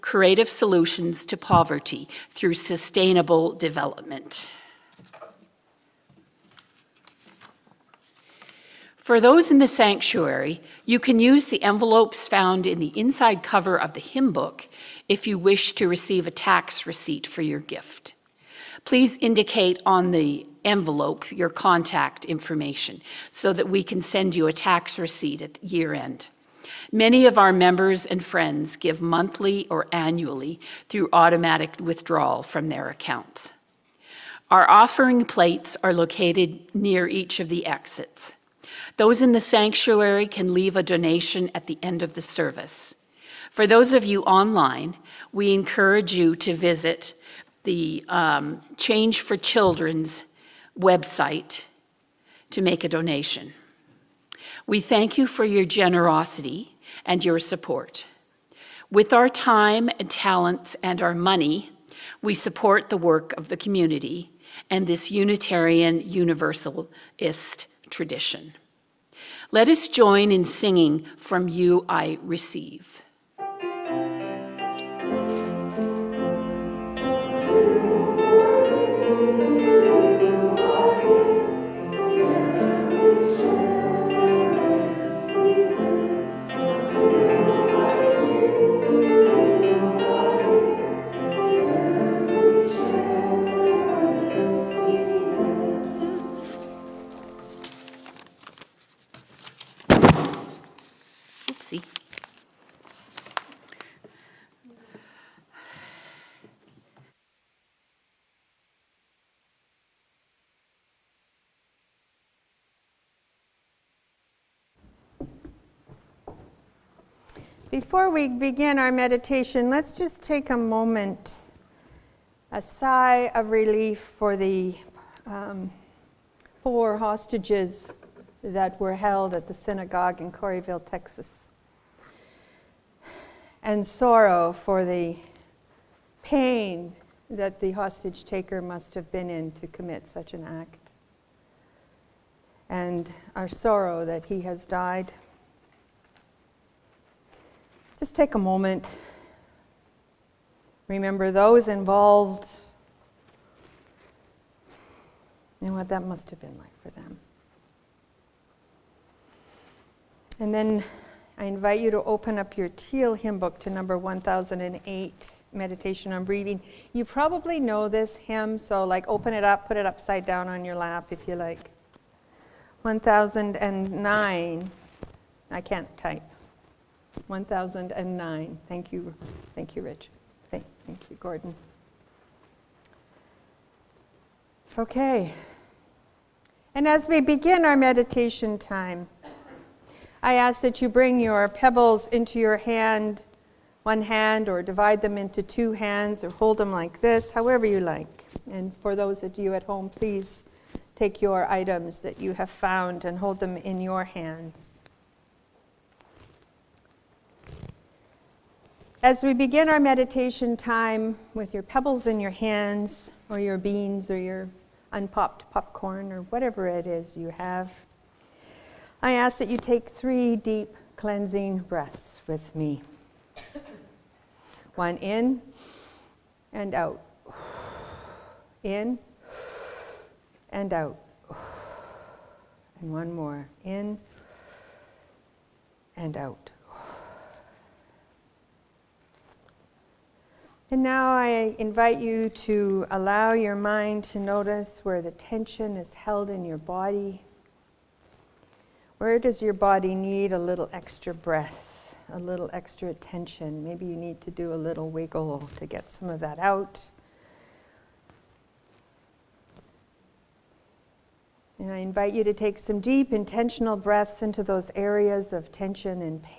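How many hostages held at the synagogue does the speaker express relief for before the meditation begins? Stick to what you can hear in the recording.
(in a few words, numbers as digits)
4.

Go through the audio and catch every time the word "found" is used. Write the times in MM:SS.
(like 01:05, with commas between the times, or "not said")
00:12, 03:22.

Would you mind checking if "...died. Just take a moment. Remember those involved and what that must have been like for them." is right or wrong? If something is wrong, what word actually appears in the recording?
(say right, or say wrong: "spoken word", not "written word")
right.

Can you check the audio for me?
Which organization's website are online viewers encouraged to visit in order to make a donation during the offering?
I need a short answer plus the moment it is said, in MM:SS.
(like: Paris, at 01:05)
Change for Children, at 00:48.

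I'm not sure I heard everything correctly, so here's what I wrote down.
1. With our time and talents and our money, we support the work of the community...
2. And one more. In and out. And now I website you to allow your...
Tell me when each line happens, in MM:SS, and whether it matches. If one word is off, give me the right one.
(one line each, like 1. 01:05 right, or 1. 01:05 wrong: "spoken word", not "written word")
1. 00:58 right
2. 03:52 wrong: "invite", not "website".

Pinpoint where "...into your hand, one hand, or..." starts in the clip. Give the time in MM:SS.
03:12.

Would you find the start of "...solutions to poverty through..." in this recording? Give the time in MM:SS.
00:00.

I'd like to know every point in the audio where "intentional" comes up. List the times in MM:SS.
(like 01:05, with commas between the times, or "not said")
04:23.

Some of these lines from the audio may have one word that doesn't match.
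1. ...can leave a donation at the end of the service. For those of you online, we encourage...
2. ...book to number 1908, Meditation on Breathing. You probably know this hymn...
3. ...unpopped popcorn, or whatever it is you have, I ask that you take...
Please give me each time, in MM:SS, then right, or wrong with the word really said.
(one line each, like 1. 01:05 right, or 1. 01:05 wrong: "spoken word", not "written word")
1. 00:40 right
2. 02:43 wrong: "1008", not "1908"
3. 03:34 right.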